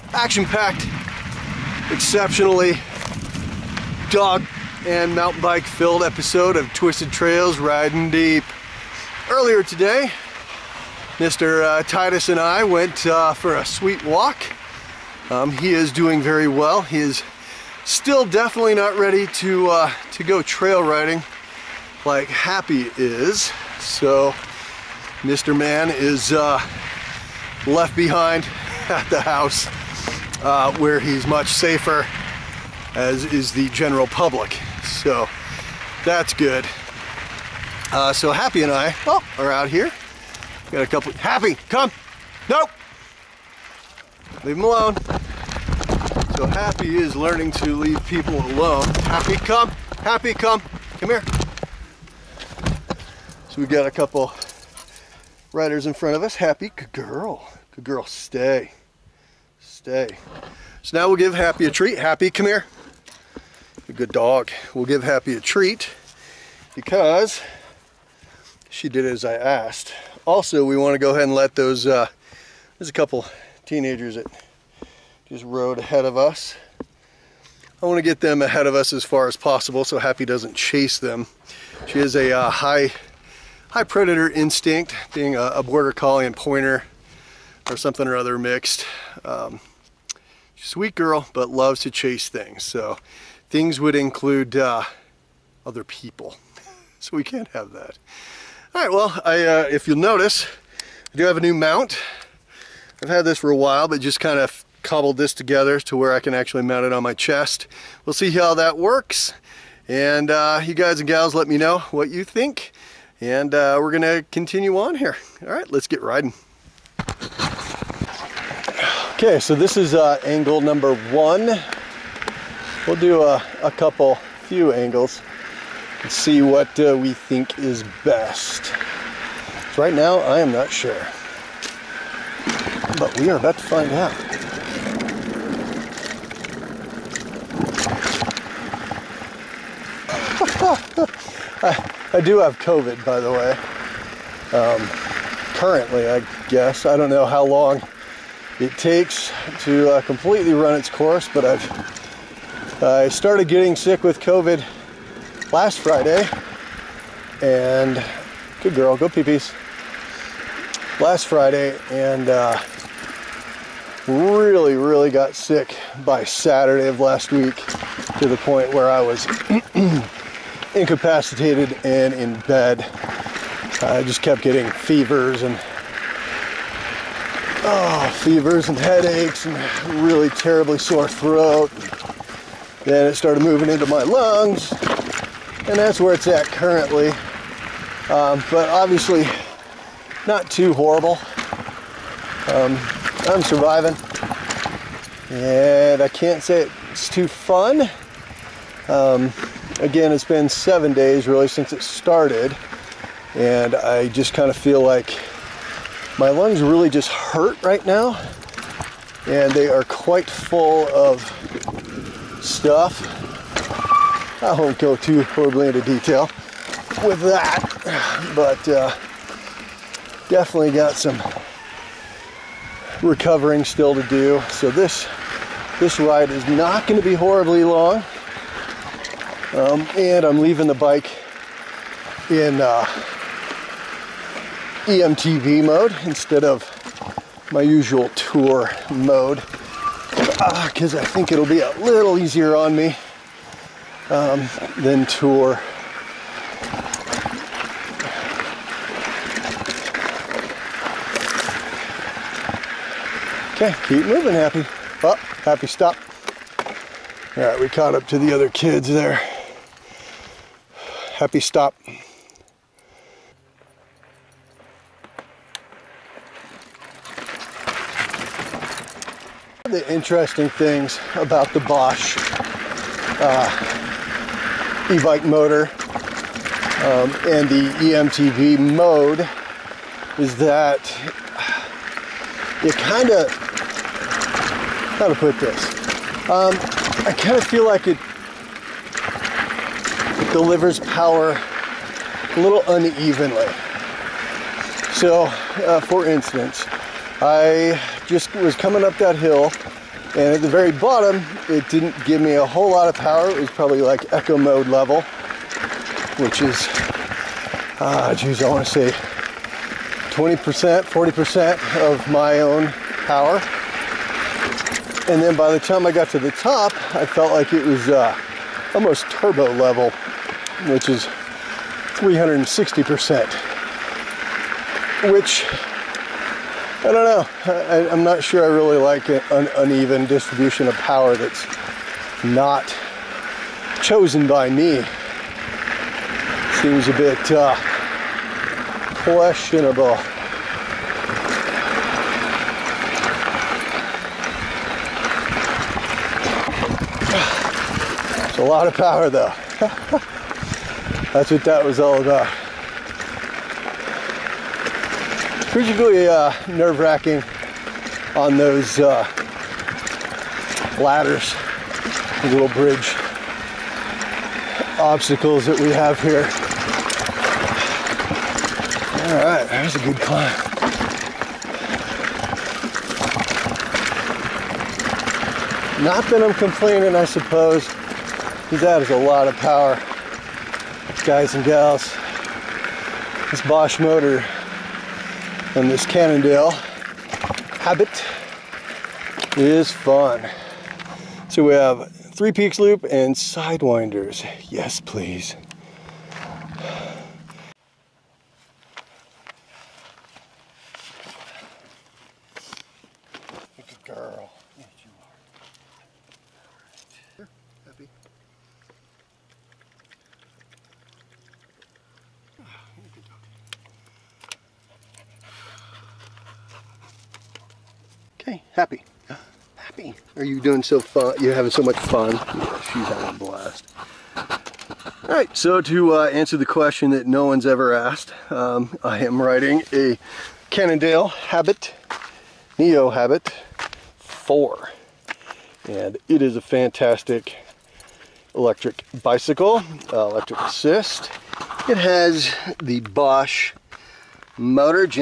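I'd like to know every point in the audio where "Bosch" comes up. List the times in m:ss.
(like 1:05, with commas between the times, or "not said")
4:31, 6:23, 7:22.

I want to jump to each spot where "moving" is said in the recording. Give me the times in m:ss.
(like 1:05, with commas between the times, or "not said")
3:03, 4:14.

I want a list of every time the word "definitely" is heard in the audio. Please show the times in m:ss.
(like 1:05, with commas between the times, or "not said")
0:18, 3:40.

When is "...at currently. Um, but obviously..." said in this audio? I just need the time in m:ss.
3:06.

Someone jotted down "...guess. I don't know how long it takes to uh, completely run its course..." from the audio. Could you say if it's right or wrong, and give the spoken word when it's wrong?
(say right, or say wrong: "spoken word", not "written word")
right.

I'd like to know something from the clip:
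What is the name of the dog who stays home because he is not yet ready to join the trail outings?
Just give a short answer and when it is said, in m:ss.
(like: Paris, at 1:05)
Titus, at 0:11.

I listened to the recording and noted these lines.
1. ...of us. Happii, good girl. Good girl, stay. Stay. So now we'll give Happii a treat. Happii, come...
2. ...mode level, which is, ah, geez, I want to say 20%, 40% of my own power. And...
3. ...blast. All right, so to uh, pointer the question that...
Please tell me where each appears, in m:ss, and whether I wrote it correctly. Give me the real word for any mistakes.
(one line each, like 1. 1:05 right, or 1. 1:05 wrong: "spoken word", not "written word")
1. 0:56 right
2. 5:04 right
3. 7:03 wrong: "answer", not "pointer".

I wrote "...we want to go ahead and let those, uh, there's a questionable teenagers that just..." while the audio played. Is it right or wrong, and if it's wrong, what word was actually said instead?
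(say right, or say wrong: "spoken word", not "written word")
wrong: "couple", not "questionable".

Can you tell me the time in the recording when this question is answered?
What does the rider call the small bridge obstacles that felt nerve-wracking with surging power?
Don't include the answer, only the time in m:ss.
6:00.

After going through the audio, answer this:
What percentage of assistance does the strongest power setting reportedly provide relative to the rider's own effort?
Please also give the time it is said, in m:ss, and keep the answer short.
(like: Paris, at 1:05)
360%, at 5:21.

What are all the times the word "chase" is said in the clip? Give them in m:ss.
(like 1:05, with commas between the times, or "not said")
1:20, 1:31.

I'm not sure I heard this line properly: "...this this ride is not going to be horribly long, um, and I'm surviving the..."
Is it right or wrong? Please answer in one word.
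wrong.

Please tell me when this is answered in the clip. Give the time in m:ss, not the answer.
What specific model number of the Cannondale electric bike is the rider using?
7:12.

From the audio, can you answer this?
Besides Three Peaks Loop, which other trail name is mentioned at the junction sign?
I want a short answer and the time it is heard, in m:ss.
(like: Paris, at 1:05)
Sidewinders, at 6:33.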